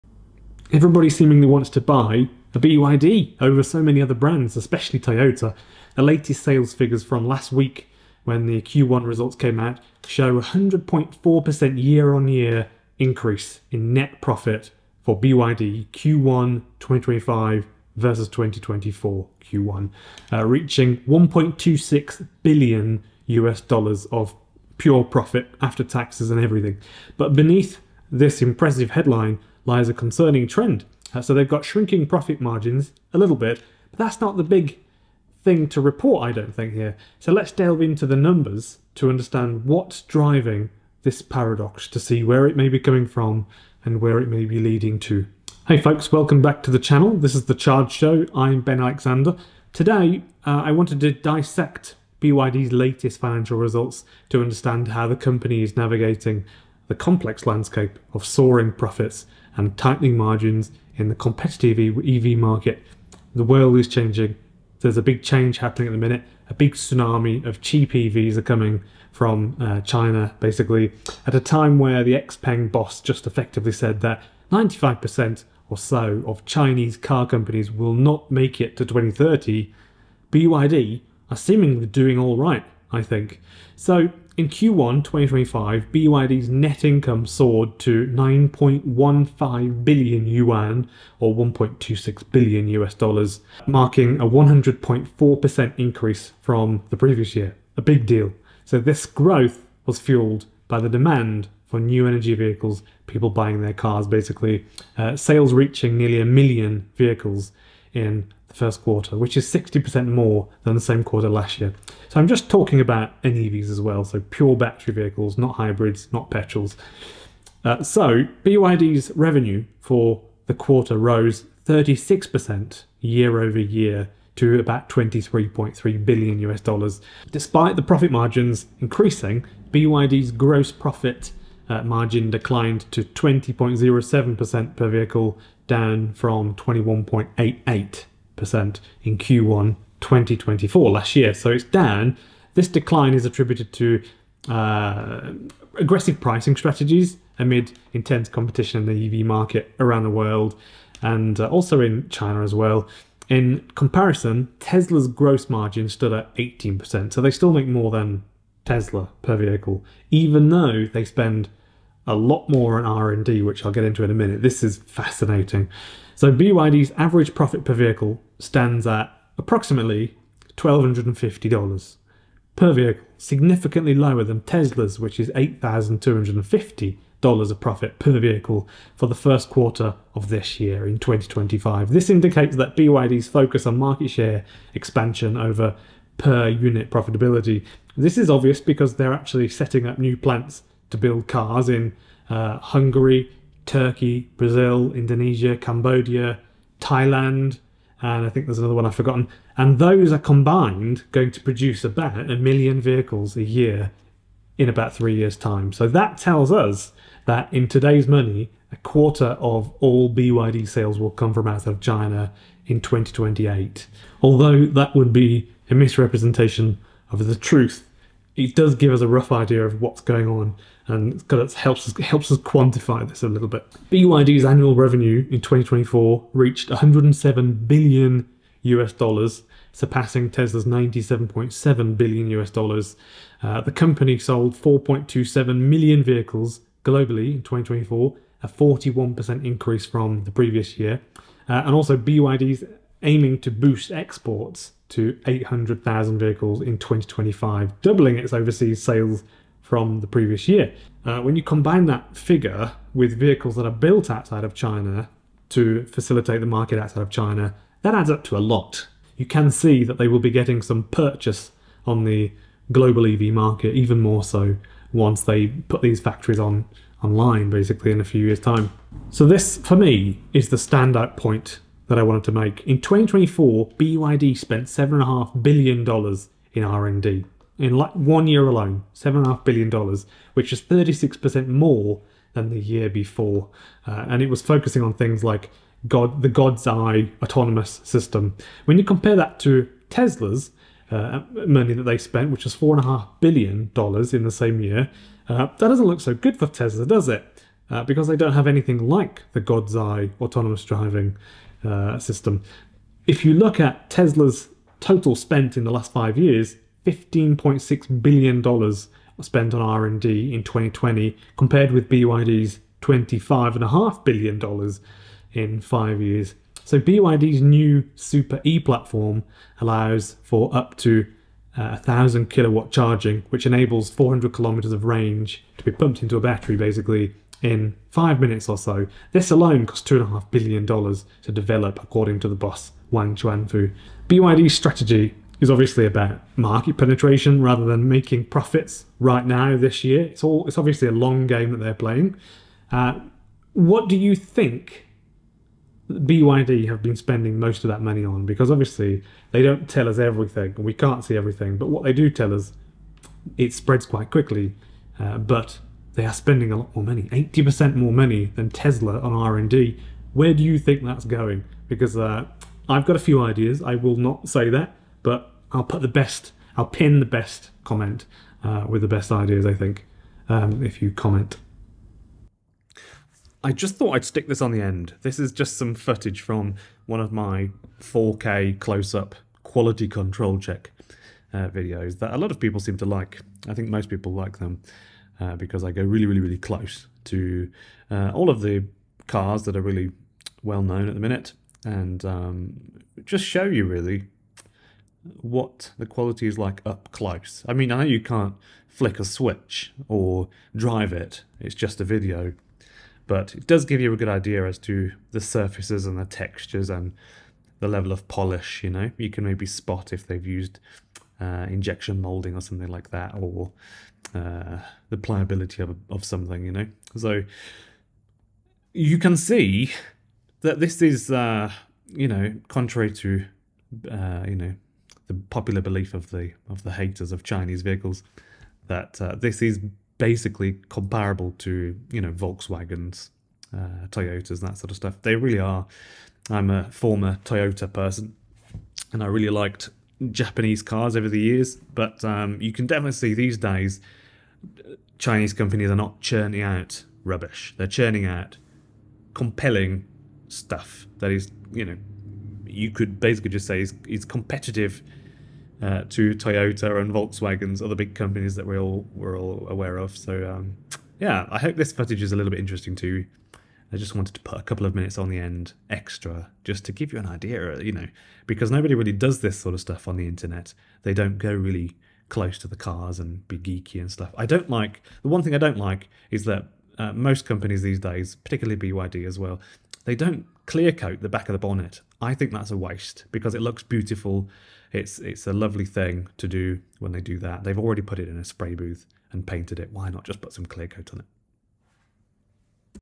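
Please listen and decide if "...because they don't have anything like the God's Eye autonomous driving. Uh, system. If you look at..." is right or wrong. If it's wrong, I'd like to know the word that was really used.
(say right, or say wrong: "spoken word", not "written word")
right.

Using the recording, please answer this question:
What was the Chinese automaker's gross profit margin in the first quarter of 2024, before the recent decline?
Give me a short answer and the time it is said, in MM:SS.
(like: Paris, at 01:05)
21.88%, at 02:16.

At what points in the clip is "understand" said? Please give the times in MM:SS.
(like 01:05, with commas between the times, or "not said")
00:39, 00:54.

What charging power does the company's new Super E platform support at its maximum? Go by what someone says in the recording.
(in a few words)
1000 kilowatts.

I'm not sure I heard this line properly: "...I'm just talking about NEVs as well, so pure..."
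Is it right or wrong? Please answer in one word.
right.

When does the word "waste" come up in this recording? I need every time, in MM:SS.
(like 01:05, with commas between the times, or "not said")
08:02.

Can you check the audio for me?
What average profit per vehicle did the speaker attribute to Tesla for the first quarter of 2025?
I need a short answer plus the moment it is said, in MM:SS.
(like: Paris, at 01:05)
$8,250, at 02:55.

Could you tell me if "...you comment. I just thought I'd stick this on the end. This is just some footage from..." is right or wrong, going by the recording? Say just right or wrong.
right.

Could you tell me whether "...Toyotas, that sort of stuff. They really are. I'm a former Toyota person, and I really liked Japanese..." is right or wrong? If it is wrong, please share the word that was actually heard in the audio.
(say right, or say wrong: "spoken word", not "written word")
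right.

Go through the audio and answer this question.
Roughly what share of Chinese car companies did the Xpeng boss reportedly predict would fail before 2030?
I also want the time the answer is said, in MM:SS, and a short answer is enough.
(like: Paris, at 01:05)
95%, at 01:14.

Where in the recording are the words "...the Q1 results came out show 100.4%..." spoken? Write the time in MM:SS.
00:08.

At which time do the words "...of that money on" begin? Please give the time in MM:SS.
05:47.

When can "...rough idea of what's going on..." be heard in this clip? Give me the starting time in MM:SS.
03:39.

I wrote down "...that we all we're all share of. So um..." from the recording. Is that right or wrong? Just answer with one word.
wrong.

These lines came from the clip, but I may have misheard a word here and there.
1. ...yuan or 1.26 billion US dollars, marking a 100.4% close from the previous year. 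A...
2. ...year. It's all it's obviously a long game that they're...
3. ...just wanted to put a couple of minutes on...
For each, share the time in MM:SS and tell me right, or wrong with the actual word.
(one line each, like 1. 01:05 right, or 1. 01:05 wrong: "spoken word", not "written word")
1. 01:30 wrong: "increase", not "close"
2. 05:39 right
3. 07:43 right.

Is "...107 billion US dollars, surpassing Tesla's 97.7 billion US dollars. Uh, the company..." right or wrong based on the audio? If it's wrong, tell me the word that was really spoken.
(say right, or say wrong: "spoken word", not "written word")
right.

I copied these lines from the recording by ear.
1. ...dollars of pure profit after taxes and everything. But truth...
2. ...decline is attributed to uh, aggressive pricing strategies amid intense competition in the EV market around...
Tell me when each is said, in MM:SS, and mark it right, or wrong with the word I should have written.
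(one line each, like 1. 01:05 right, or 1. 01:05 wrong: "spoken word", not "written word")
1. 00:23 wrong: "beneath", not "truth"
2. 02:22 right.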